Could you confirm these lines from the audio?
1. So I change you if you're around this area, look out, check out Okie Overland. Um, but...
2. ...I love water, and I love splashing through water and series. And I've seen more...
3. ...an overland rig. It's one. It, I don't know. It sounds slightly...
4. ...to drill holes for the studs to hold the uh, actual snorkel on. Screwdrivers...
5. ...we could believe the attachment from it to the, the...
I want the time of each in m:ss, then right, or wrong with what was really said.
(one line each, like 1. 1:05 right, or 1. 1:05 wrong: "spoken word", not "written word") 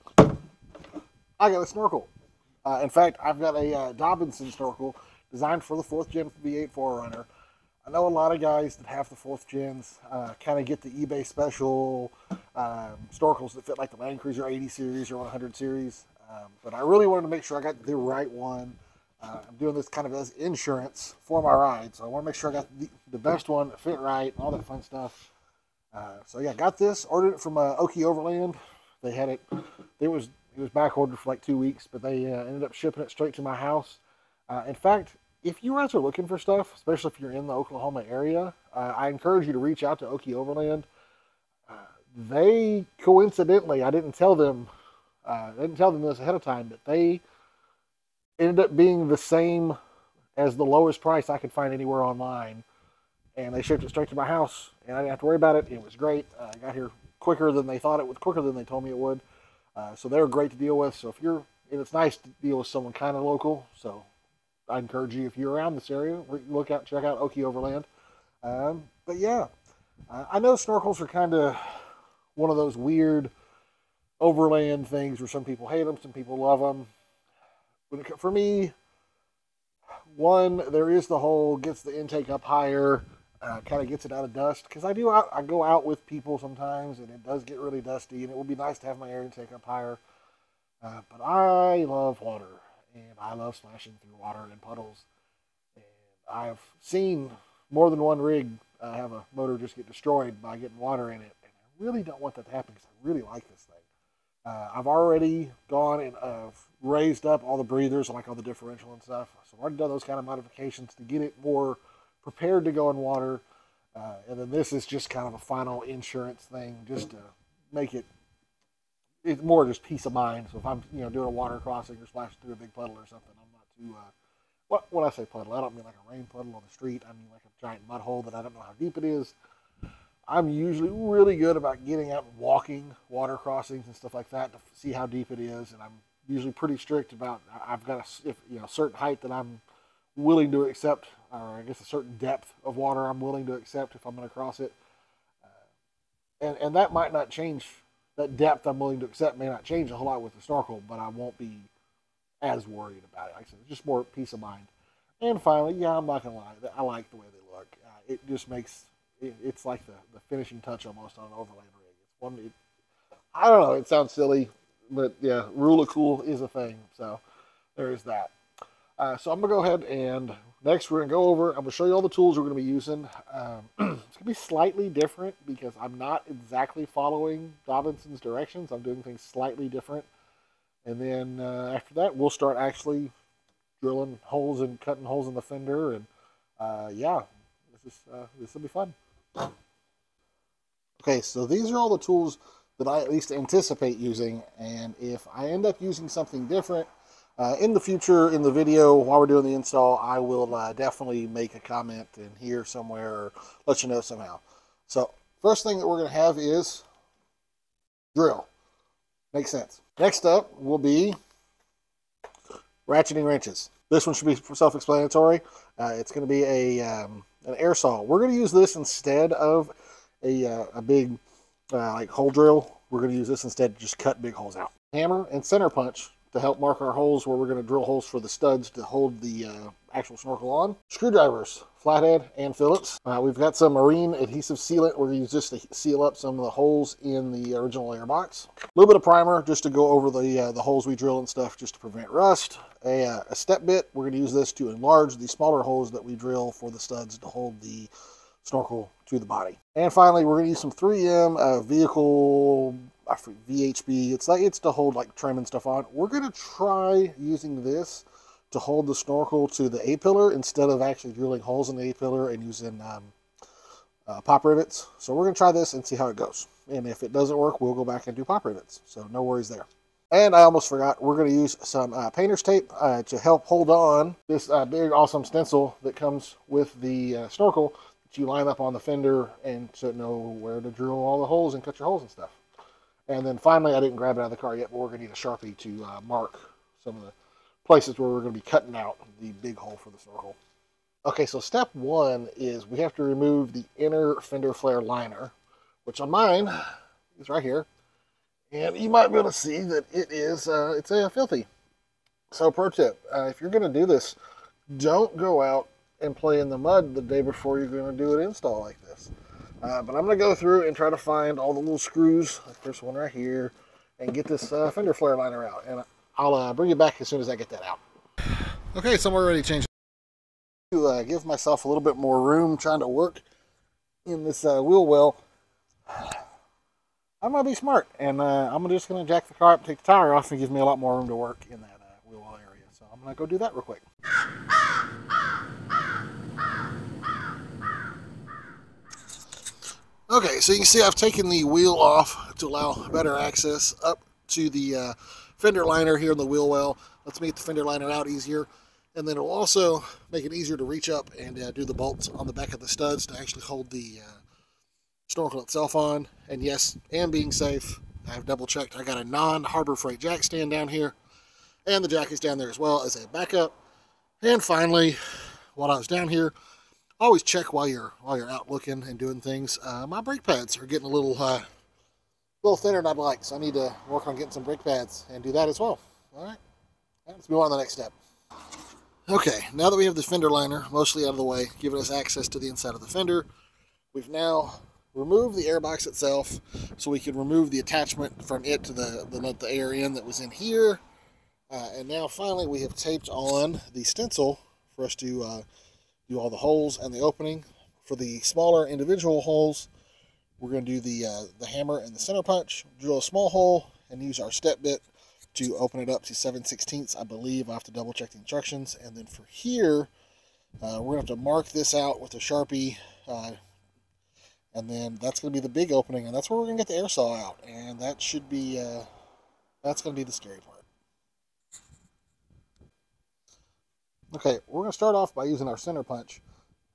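1. 1:03 wrong: "encourage", not "change"
2. 1:31 wrong: "puddles", not "series"
3. 2:41 wrong: "silly", not "slightly"
4. 3:47 right
5. 6:26 wrong: "remove", not "believe".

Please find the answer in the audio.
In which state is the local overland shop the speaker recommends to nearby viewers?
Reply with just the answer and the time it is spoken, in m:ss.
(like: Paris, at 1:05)
Oklahoma, at 0:37.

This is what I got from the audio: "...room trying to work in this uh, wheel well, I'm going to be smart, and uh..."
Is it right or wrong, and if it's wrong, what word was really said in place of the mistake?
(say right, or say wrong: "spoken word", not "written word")
right.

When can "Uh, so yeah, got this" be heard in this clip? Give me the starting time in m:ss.
0:25.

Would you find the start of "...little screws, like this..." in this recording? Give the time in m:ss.
5:11.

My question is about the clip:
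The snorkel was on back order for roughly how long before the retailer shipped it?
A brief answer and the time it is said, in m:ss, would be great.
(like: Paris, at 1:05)
2 weeks, at 0:31.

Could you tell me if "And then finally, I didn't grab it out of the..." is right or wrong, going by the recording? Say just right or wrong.
right.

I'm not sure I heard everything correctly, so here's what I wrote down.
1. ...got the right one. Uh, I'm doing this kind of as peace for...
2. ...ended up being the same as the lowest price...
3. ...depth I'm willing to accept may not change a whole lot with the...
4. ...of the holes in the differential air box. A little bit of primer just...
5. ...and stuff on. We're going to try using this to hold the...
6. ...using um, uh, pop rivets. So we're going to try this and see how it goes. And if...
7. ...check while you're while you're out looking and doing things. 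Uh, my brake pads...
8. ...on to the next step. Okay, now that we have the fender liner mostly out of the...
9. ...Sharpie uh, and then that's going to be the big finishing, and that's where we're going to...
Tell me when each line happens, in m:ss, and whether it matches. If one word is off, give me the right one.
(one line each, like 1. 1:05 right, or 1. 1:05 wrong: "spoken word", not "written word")
1. 0:17 wrong: "insurance", not "peace"
2. 0:48 right
3. 2:28 right
4. 3:56 wrong: "original", not "differential"
5. 4:15 right
6. 4:22 right
7. 6:07 right
8. 6:17 right
9. 6:52 wrong: "opening", not "finishing".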